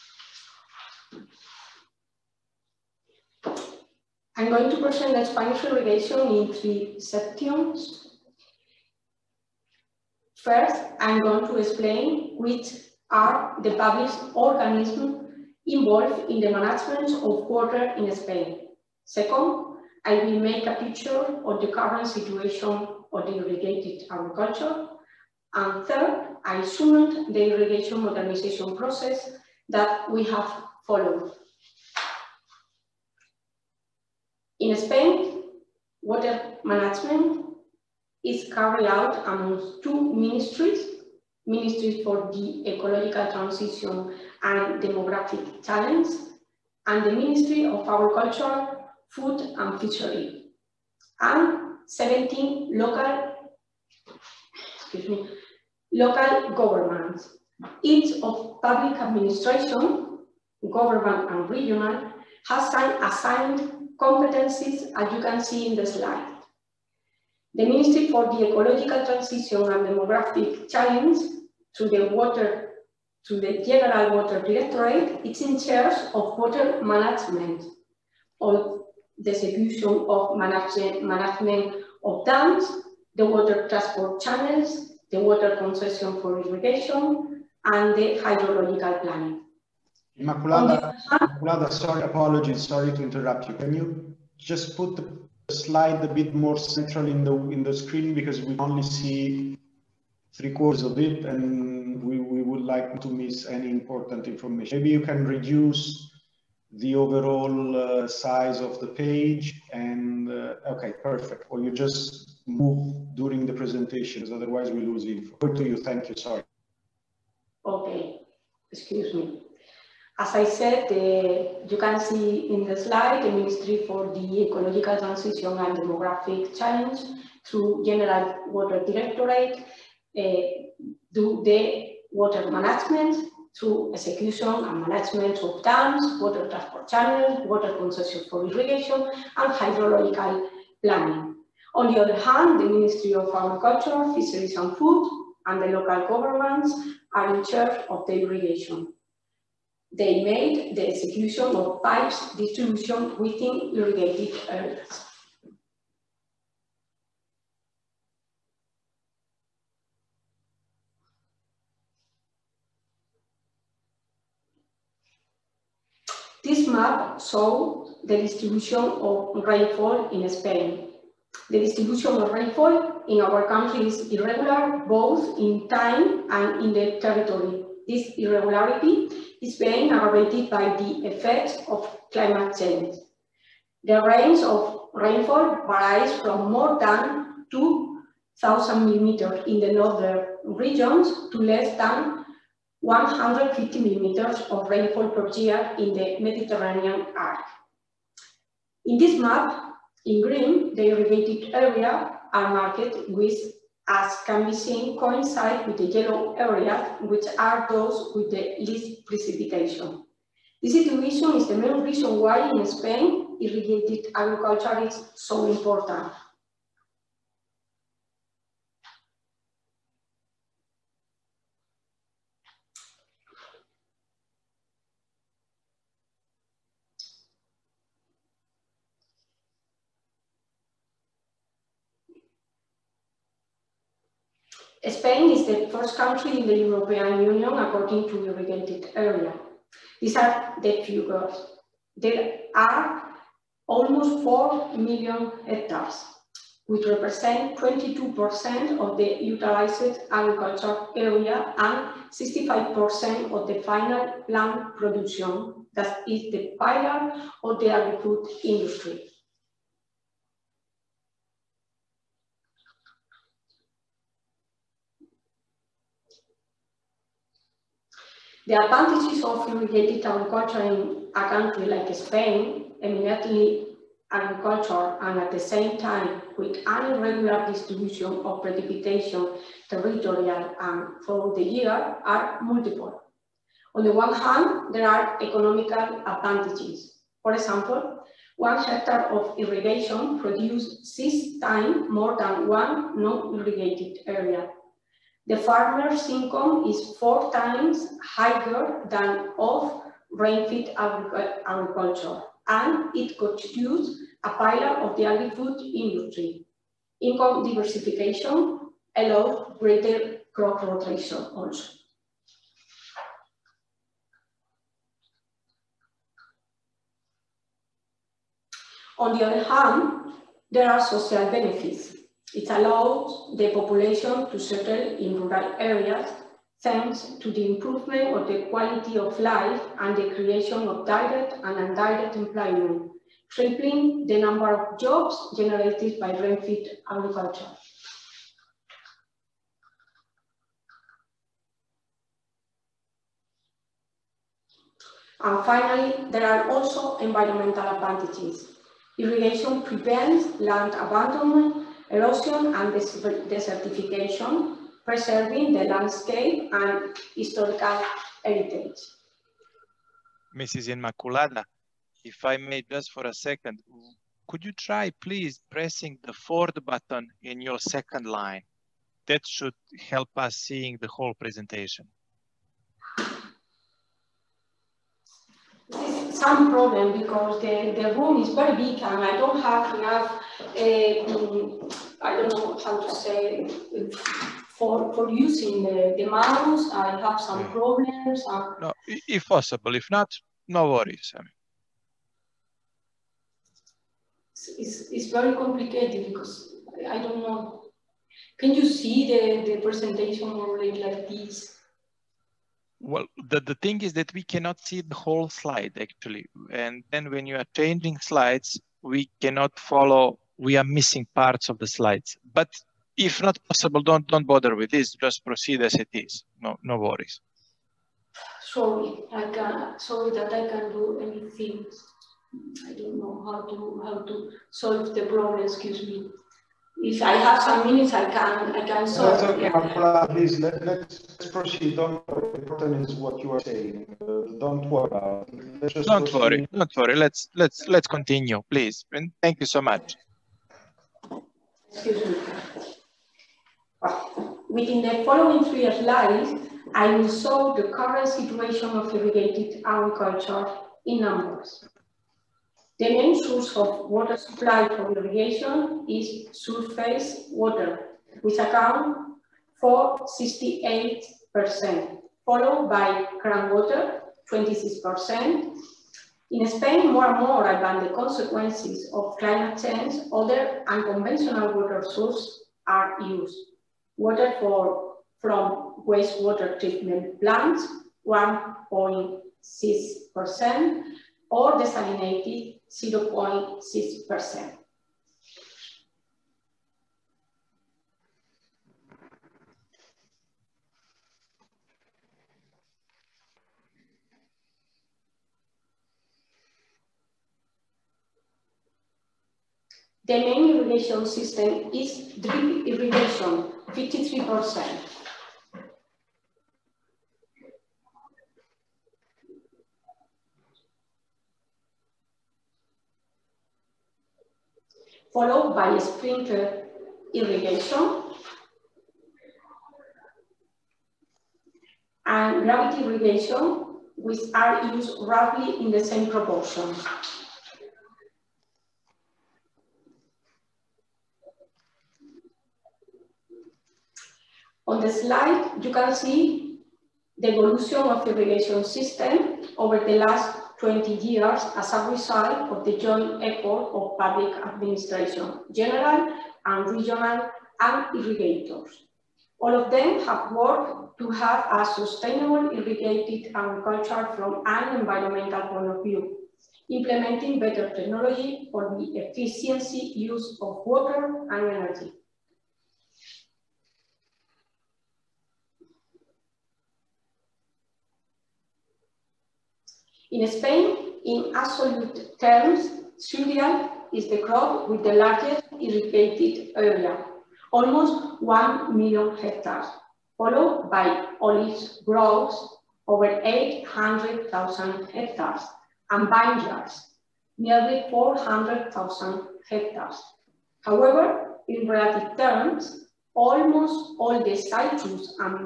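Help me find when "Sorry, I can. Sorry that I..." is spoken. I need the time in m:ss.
6:58.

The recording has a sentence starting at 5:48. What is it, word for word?
Irrigation prevents land abandonment erosion and desertification, preserving the landscape and historical heritage.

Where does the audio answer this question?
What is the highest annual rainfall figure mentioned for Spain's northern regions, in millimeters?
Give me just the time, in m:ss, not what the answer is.
3:06.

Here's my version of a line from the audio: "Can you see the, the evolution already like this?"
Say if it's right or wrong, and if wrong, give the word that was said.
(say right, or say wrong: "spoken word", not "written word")
wrong: "presentation", not "evolution".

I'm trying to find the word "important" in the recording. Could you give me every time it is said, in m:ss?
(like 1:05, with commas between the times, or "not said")
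1:43, 3:35, 7:12.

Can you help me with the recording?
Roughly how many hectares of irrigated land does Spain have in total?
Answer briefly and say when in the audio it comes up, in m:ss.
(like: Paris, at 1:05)
almost 4 million, at 4:03.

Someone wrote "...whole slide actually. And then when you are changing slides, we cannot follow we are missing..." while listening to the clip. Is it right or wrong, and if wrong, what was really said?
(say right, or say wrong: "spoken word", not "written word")
right.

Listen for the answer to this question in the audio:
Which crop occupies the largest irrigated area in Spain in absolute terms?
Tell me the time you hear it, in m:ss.
9:32.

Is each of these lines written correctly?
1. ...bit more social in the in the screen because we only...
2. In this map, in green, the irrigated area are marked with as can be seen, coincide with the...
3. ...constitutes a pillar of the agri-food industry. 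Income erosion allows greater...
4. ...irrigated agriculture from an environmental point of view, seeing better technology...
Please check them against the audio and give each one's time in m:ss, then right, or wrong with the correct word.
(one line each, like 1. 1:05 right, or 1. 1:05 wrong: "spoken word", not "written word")
1. 1:36 wrong: "central", not "social"
2. 3:18 right
3. 5:03 wrong: "diversification", not "erosion"
4. 9:12 wrong: "implementing", not "seeing".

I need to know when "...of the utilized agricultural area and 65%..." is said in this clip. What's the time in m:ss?
4:08.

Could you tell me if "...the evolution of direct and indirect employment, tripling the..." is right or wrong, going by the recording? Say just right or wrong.
wrong.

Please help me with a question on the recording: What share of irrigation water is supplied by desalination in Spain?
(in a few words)
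0.6%.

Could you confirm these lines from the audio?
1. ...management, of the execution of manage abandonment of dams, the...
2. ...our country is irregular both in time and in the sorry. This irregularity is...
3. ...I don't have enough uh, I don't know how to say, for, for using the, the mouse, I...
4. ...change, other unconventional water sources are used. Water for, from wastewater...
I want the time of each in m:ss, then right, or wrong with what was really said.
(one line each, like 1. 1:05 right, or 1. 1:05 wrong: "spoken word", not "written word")
1. 1:16 wrong: "management", not "abandonment"
2. 2:53 wrong: "territory", not "sorry"
3. 6:19 right
4. 7:49 right.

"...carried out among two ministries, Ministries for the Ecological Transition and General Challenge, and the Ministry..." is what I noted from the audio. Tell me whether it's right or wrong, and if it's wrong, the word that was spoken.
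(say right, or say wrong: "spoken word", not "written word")
wrong: "Demographic", not "General".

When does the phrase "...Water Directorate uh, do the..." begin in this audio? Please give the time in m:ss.
2:08.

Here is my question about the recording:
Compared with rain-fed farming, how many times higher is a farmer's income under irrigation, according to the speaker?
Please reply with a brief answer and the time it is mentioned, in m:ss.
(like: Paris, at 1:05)
4 times, at 4:56.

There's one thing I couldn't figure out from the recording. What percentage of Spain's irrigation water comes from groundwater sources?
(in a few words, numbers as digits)
26%.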